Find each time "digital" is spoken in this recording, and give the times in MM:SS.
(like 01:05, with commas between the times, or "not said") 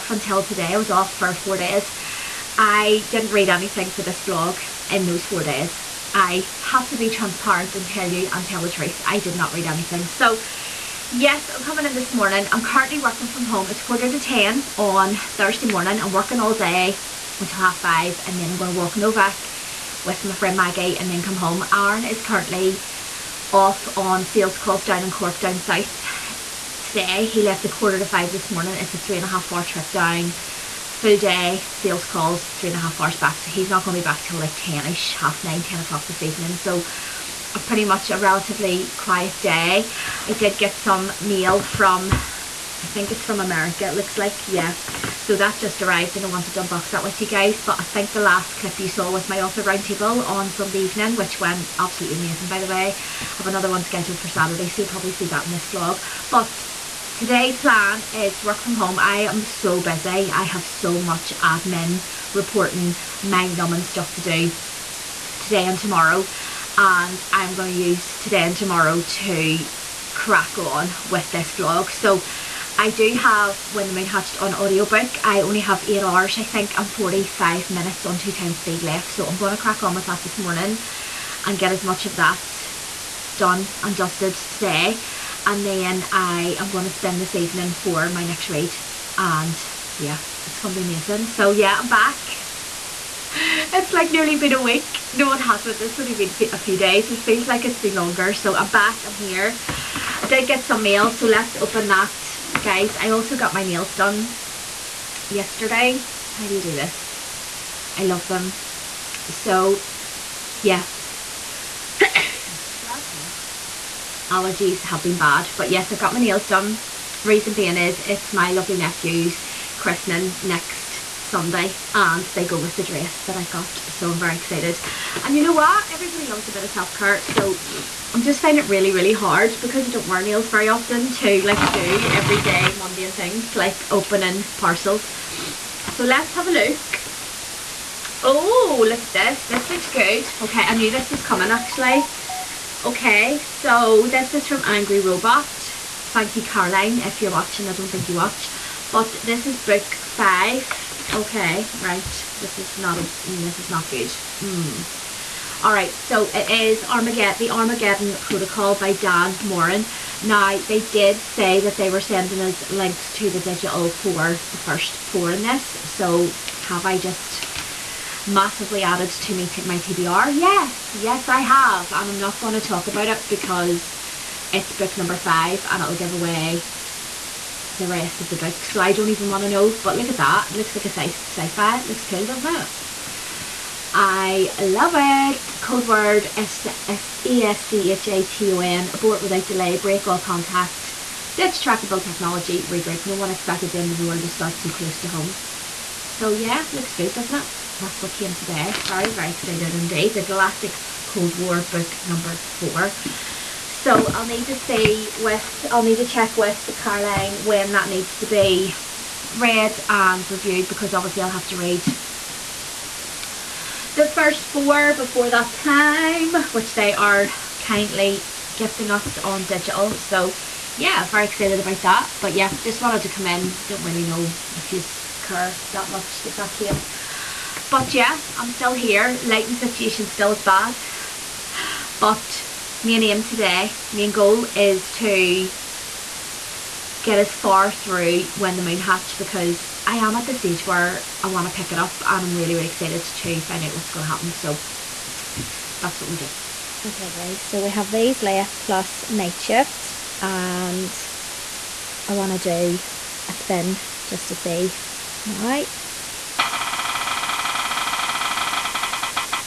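02:43, 03:39.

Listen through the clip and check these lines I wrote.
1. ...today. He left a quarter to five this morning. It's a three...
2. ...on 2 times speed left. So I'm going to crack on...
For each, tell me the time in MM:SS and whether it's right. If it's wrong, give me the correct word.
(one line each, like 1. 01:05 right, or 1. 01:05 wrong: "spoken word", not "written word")
1. 00:26 right
2. 01:18 right.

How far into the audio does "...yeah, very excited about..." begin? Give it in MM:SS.
03:40.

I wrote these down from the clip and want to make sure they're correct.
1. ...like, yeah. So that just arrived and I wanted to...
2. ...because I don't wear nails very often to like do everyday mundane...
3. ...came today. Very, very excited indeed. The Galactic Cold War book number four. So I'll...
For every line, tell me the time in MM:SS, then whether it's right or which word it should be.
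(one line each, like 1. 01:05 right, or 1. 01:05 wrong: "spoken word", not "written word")
1. 00:44 right
2. 02:09 right
3. 03:18 right.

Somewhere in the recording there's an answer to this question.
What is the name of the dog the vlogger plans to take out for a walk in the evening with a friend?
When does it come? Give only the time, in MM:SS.
00:18.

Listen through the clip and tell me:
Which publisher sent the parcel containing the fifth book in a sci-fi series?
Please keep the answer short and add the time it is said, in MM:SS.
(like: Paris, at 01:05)
Angry Robot, at 02:24.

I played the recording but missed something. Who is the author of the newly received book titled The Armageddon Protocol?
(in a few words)
Dan Moren.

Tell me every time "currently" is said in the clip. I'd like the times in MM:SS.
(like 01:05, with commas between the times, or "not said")
00:12, 00:22.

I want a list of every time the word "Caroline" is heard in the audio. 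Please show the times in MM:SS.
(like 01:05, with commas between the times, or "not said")
02:26, 03:26.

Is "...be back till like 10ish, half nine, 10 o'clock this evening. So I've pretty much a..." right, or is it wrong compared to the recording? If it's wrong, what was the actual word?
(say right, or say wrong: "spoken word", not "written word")
right.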